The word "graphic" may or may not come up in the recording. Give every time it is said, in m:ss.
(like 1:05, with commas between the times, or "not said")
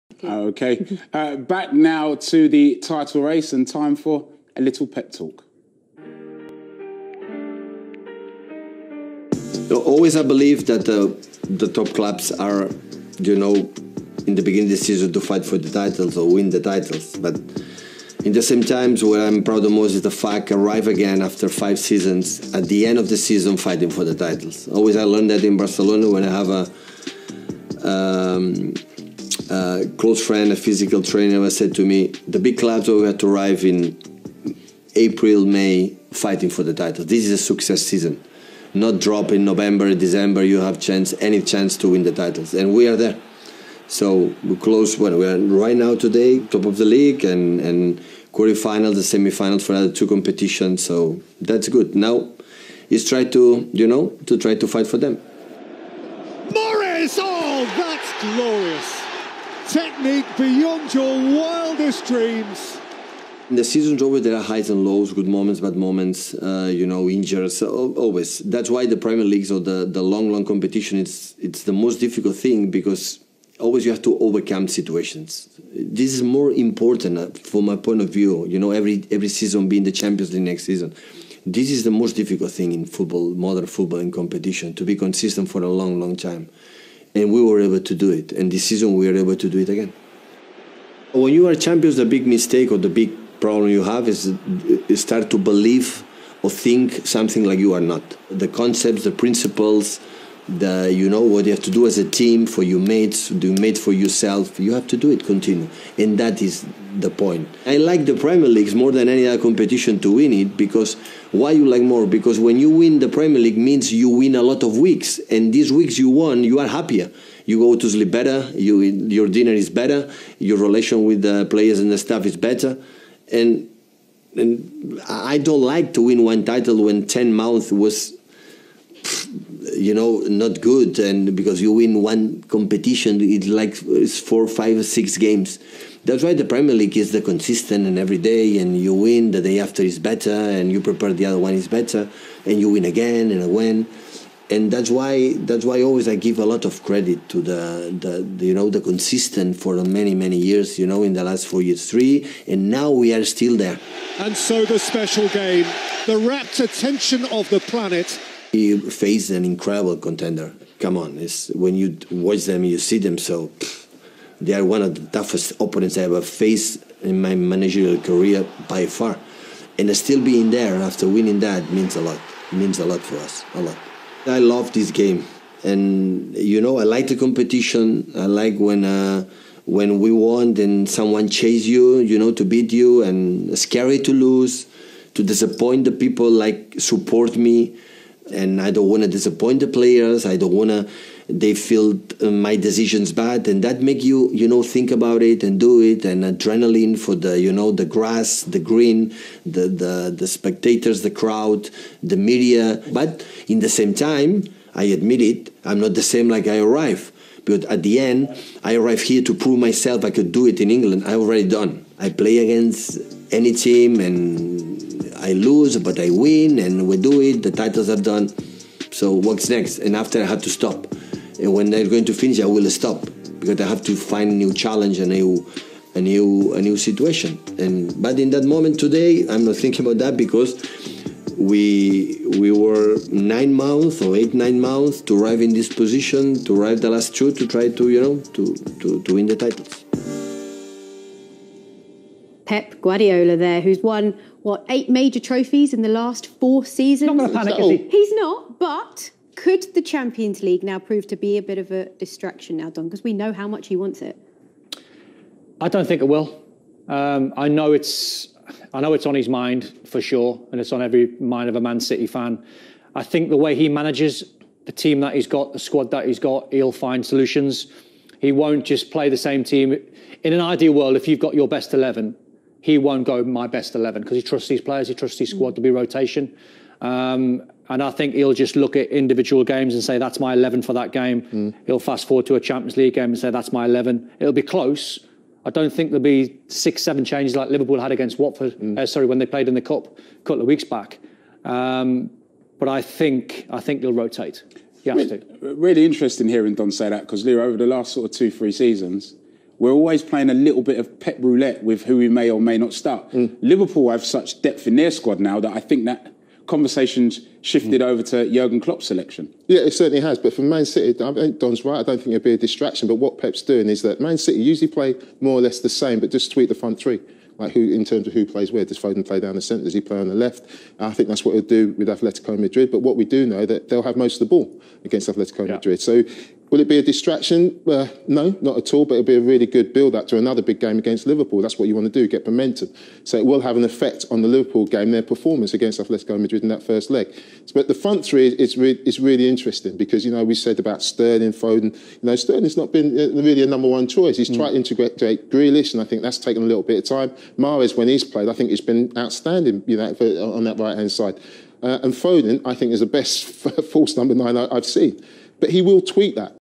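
not said.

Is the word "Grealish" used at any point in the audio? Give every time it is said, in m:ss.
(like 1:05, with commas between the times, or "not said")
5:45.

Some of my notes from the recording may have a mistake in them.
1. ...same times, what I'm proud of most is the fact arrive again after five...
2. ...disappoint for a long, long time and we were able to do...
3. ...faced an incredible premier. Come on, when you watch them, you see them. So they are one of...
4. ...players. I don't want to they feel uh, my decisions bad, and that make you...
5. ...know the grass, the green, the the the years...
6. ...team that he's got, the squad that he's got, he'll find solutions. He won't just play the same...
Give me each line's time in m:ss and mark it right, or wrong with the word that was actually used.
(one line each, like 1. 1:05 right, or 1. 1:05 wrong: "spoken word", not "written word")
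1. 0:18 right
2. 1:24 wrong: "consistent", not "disappoint"
3. 2:38 wrong: "contender", not "premier"
4. 3:09 right
5. 3:17 wrong: "spectators", not "years"
6. 4:24 right.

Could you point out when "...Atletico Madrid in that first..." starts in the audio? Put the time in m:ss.
5:35.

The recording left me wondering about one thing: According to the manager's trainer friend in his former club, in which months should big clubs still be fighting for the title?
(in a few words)
April, May.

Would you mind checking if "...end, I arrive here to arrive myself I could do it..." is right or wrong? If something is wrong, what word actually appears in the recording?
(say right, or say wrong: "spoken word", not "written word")
wrong: "prove", not "arrive".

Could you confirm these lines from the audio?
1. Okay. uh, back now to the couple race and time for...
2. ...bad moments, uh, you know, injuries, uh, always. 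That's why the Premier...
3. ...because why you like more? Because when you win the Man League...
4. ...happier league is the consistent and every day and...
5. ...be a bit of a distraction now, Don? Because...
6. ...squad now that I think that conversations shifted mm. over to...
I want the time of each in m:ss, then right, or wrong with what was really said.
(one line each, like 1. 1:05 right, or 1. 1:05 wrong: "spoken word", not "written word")
1. 0:00 wrong: "title", not "couple"
2. 1:05 right
3. 1:50 wrong: "Premier", not "Man"
4. 2:16 wrong: "premier", not "happier"
5. 4:11 right
6. 5:04 right.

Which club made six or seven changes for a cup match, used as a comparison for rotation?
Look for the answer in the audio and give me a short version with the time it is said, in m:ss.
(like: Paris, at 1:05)
Watford, at 4:48.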